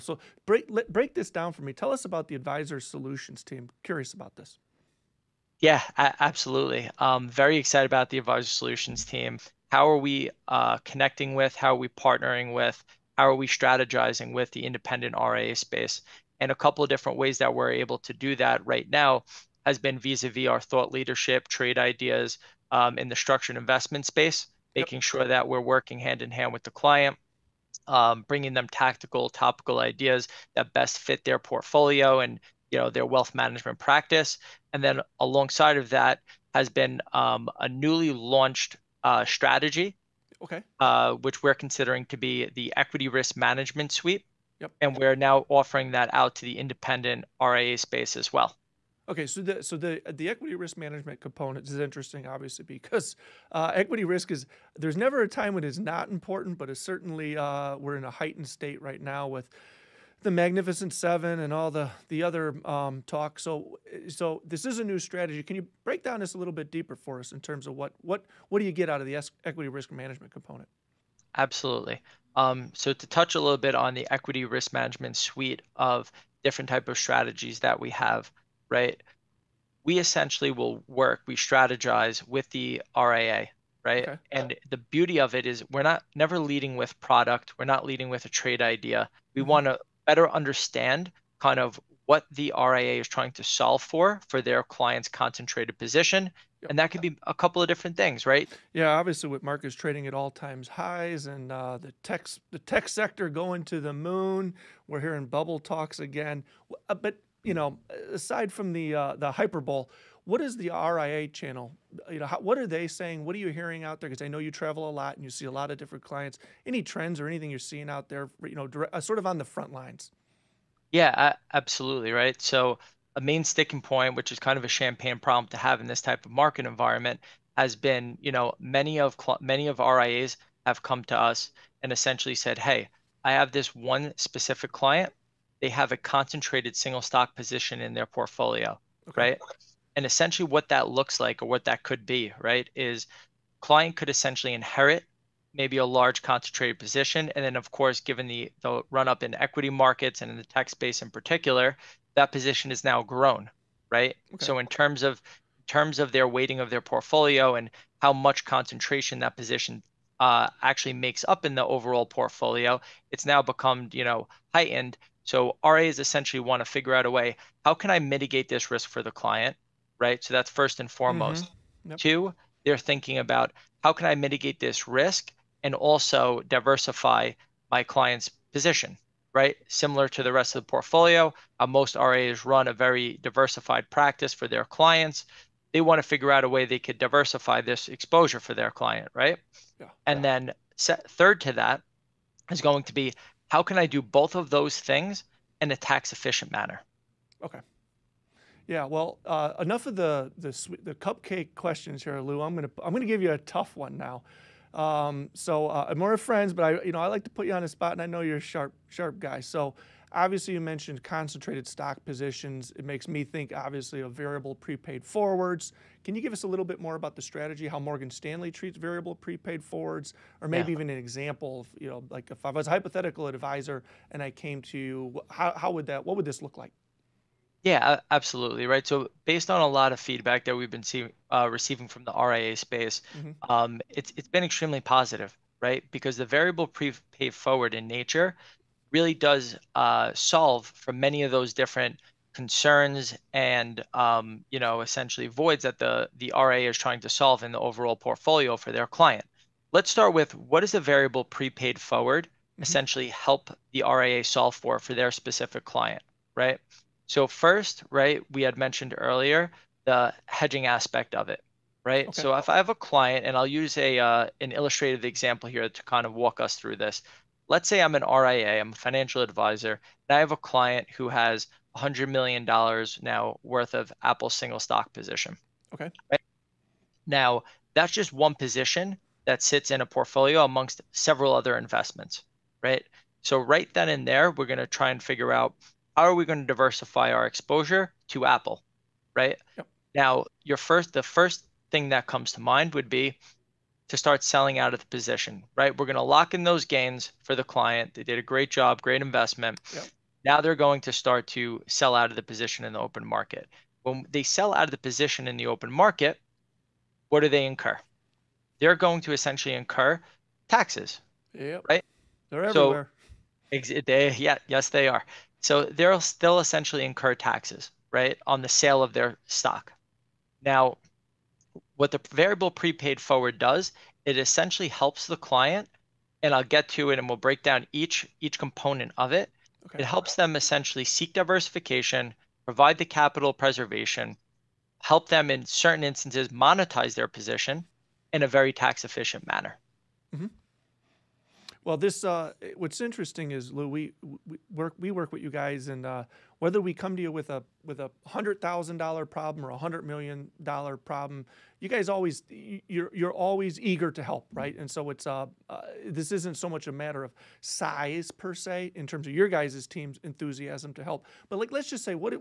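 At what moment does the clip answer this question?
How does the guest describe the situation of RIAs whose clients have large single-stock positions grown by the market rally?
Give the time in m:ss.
2:04.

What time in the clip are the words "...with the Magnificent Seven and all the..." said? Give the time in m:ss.
0:59.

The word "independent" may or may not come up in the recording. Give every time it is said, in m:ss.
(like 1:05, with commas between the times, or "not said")
0:14, 0:46.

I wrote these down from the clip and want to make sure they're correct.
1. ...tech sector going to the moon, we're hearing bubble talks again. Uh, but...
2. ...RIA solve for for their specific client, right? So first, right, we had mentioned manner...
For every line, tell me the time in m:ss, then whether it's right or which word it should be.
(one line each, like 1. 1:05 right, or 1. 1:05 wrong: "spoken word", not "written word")
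1. 1:42 right
2. 4:13 wrong: "earlier", not "manner".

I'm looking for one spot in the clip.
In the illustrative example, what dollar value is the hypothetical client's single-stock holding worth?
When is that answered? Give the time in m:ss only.
4:31.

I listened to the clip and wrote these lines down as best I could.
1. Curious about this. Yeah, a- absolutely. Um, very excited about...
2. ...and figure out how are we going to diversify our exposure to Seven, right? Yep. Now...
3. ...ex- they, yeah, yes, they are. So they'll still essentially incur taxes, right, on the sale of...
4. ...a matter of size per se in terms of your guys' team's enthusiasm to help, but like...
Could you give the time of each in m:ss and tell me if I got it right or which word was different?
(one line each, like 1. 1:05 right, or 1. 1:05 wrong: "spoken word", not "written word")
1. 0:03 right
2. 4:44 wrong: "Apple", not "Seven"
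3. 5:13 right
4. 5:56 right.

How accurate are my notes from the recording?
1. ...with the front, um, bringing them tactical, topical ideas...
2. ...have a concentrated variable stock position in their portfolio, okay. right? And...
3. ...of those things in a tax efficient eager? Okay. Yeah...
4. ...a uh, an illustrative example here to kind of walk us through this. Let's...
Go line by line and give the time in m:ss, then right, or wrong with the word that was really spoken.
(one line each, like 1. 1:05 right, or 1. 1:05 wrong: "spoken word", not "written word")
1. 0:26 wrong: "client", not "front"
2. 2:15 wrong: "single", not "variable"
3. 3:14 wrong: "manner", not "eager"
4. 4:23 right.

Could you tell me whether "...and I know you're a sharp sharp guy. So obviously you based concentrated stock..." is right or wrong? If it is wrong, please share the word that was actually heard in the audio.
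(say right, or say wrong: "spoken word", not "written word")
wrong: "mentioned", not "based".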